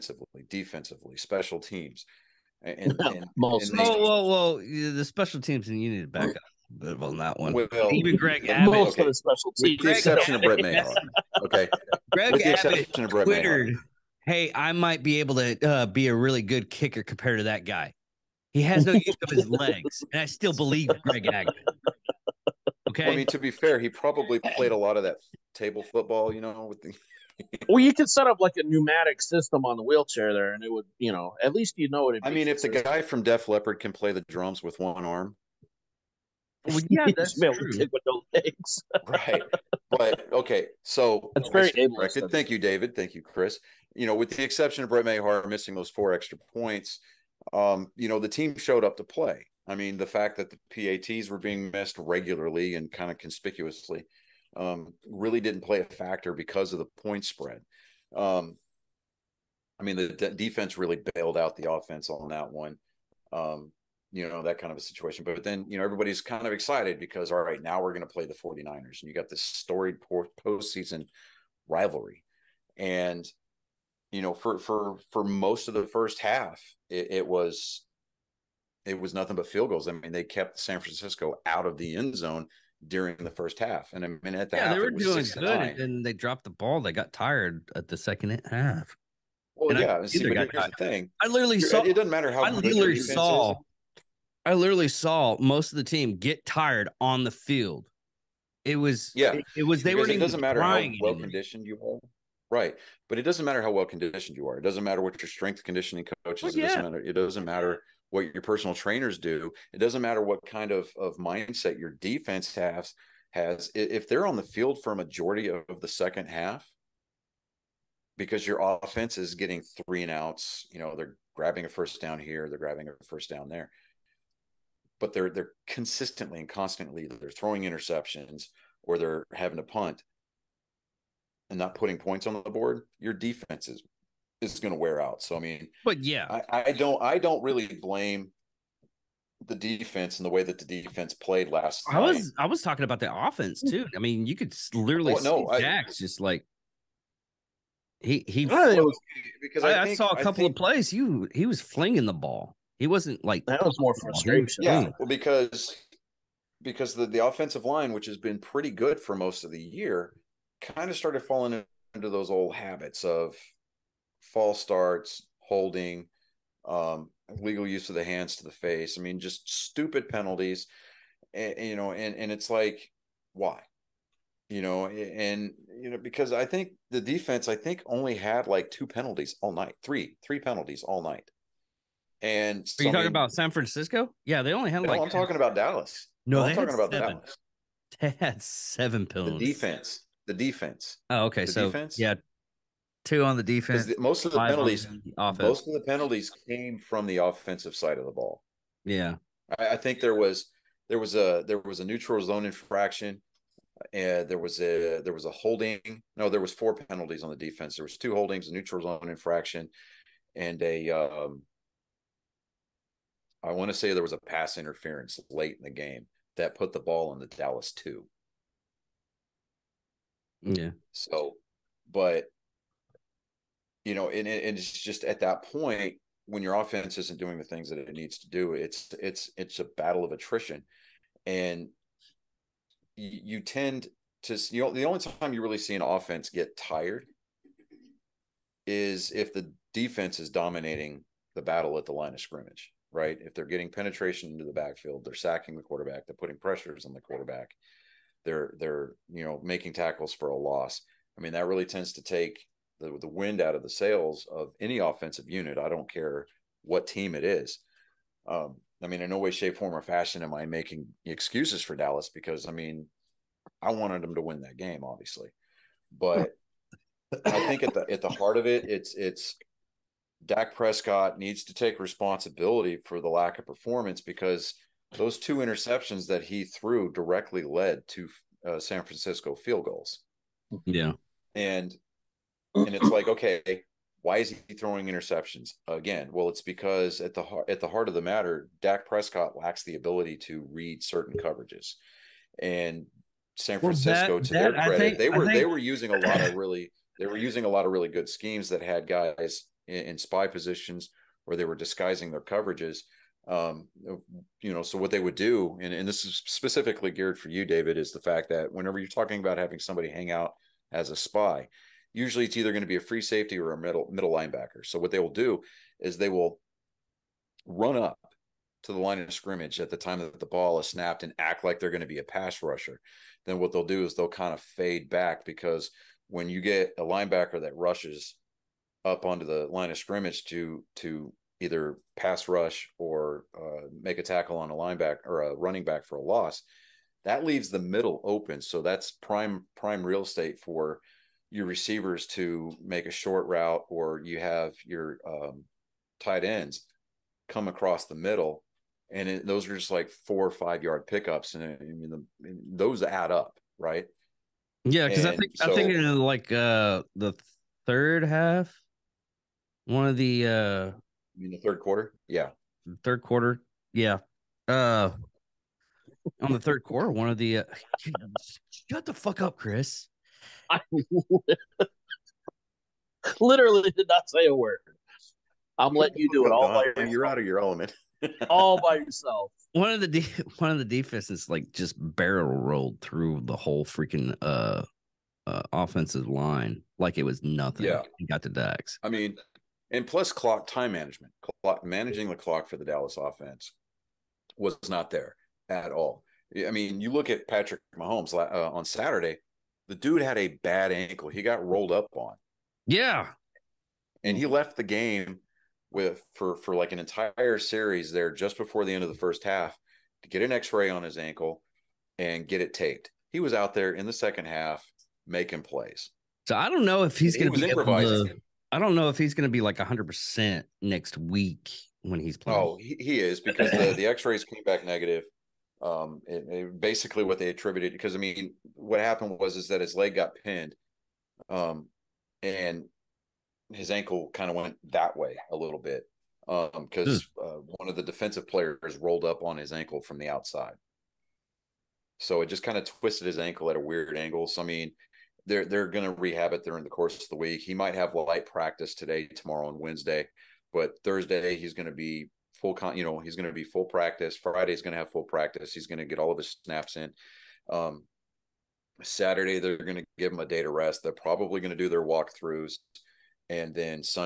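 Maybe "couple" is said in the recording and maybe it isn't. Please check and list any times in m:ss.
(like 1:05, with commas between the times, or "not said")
2:30.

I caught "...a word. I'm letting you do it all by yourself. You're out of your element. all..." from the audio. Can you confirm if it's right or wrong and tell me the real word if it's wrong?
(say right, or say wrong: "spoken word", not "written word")
right.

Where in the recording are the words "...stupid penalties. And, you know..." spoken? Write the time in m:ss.
2:49.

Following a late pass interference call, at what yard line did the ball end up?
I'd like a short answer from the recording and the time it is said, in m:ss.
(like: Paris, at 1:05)
the Dallas two, at 3:37.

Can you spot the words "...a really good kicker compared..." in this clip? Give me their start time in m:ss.
0:16.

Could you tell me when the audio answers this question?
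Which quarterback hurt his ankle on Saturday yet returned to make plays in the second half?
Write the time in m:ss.
6:37.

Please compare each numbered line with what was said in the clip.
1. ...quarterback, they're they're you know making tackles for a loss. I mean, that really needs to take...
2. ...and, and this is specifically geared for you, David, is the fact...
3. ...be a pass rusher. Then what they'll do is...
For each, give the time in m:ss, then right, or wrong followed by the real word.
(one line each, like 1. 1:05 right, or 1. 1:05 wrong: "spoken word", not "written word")
1. 4:06 wrong: "tends", not "needs"
2. 5:05 right
3. 5:21 right.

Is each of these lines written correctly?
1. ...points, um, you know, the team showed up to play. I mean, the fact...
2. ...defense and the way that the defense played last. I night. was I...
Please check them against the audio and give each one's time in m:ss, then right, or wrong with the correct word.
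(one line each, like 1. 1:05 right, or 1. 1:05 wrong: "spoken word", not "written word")
1. 0:46 right
2. 2:19 right.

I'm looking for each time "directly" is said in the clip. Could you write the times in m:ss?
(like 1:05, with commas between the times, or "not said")
4:36.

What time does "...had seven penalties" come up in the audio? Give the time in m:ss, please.
3:08.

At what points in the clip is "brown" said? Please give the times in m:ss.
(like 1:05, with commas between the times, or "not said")
not said.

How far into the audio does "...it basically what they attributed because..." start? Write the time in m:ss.
7:06.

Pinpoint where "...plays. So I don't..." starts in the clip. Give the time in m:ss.
6:55.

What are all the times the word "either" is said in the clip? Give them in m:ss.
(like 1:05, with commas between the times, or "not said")
5:12, 5:31.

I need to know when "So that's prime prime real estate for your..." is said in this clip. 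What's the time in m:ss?
5:38.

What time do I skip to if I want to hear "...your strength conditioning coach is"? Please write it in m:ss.
1:45.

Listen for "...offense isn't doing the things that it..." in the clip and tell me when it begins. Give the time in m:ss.
3:46.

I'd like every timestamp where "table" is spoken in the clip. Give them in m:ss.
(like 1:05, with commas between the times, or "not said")
0:25.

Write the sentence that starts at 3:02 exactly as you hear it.
And are you talking about San Francisco?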